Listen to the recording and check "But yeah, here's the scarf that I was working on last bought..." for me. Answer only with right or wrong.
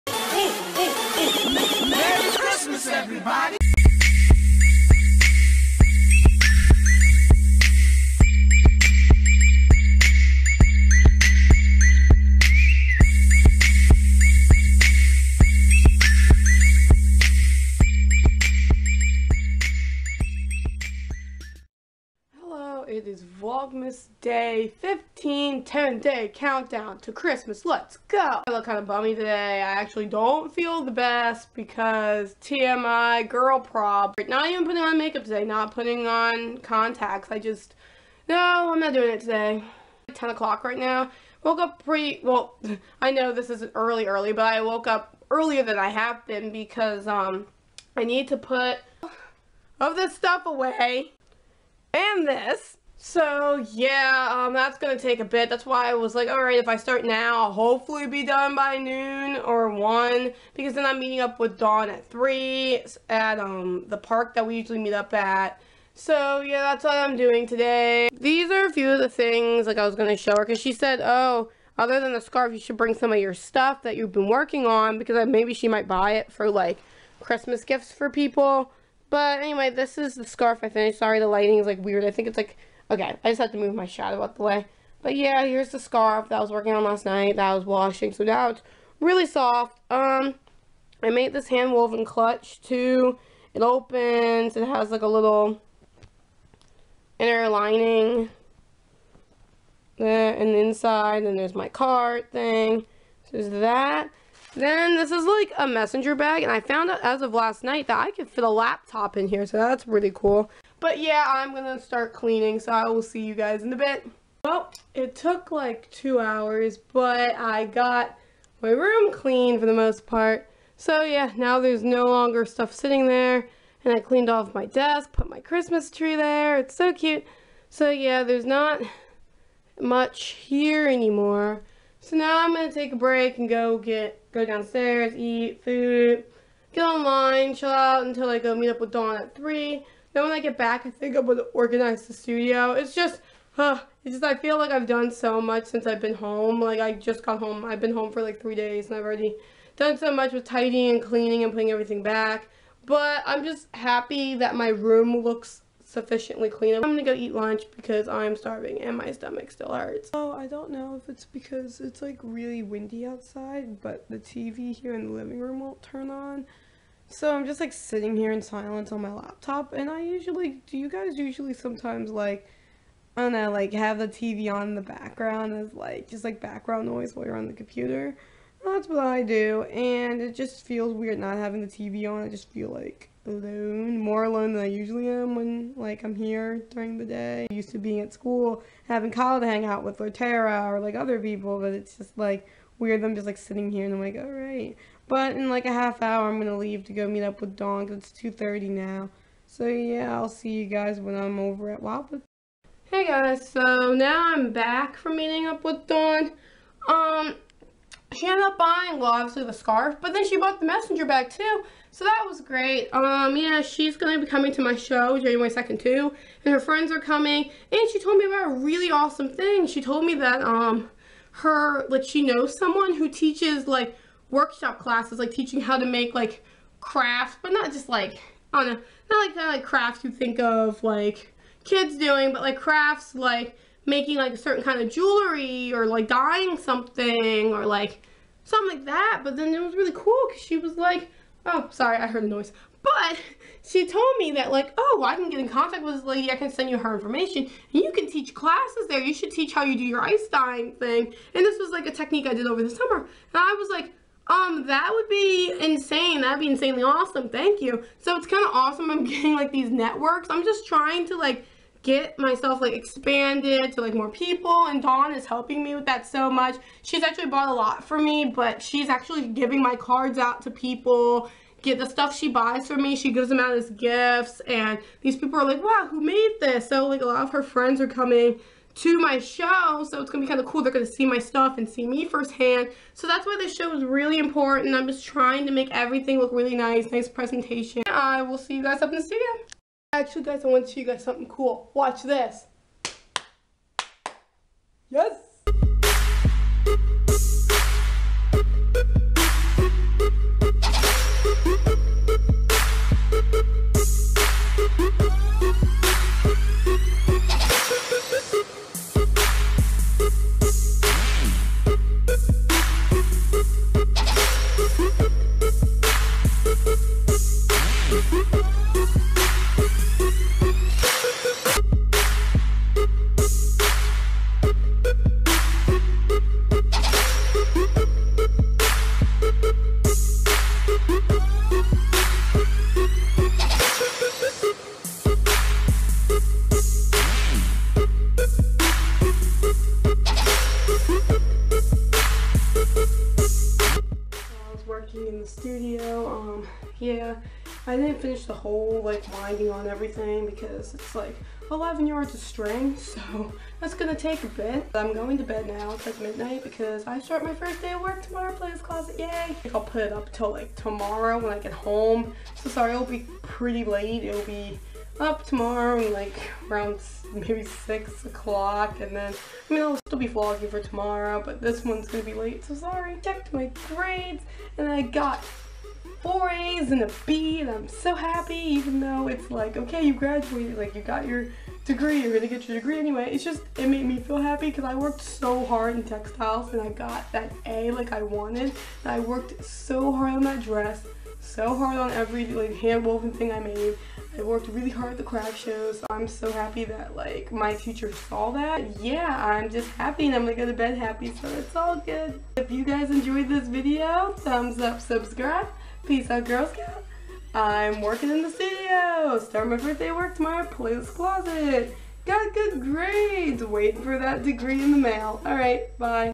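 wrong.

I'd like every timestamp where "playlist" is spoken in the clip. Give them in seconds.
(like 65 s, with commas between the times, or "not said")
not said.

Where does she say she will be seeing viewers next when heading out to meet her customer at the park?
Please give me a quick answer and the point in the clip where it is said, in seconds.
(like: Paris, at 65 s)
Wildwood, at 201 s.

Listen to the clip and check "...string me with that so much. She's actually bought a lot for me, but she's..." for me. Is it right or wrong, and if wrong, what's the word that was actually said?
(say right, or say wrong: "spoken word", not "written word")
wrong: "helping", not "string".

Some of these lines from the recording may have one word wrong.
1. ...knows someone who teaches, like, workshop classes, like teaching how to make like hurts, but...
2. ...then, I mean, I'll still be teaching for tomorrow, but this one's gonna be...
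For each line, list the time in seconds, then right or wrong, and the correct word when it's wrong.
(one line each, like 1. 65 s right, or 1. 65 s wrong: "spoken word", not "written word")
1. 222 s wrong: "crafts", not "hurts"
2. 368 s wrong: "vlogging", not "teaching".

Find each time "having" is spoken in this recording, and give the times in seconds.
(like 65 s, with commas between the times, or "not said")
181 s, 188 s.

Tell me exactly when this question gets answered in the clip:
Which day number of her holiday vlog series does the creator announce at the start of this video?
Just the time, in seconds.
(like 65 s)
24 s.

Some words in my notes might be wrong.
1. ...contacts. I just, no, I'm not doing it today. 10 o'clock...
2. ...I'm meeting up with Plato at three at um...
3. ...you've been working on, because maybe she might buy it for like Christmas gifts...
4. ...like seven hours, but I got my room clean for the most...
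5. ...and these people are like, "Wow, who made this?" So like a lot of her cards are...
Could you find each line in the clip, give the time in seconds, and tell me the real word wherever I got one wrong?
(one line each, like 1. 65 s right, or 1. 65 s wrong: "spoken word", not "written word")
1. 36 s right
2. 60 s wrong: "Dawn", not "Plato"
3. 73 s right
4. 115 s wrong: "two", not "seven"
5. 274 s wrong: "friends", not "cards".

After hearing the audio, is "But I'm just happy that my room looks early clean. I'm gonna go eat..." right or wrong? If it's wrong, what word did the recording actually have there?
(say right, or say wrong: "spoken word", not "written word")
wrong: "sufficiently", not "early".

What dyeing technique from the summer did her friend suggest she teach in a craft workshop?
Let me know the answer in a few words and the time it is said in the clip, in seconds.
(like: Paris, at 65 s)
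ice dyeing, at 250 s.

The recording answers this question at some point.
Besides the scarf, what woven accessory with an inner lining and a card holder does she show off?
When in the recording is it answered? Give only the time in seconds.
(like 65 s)
92 s.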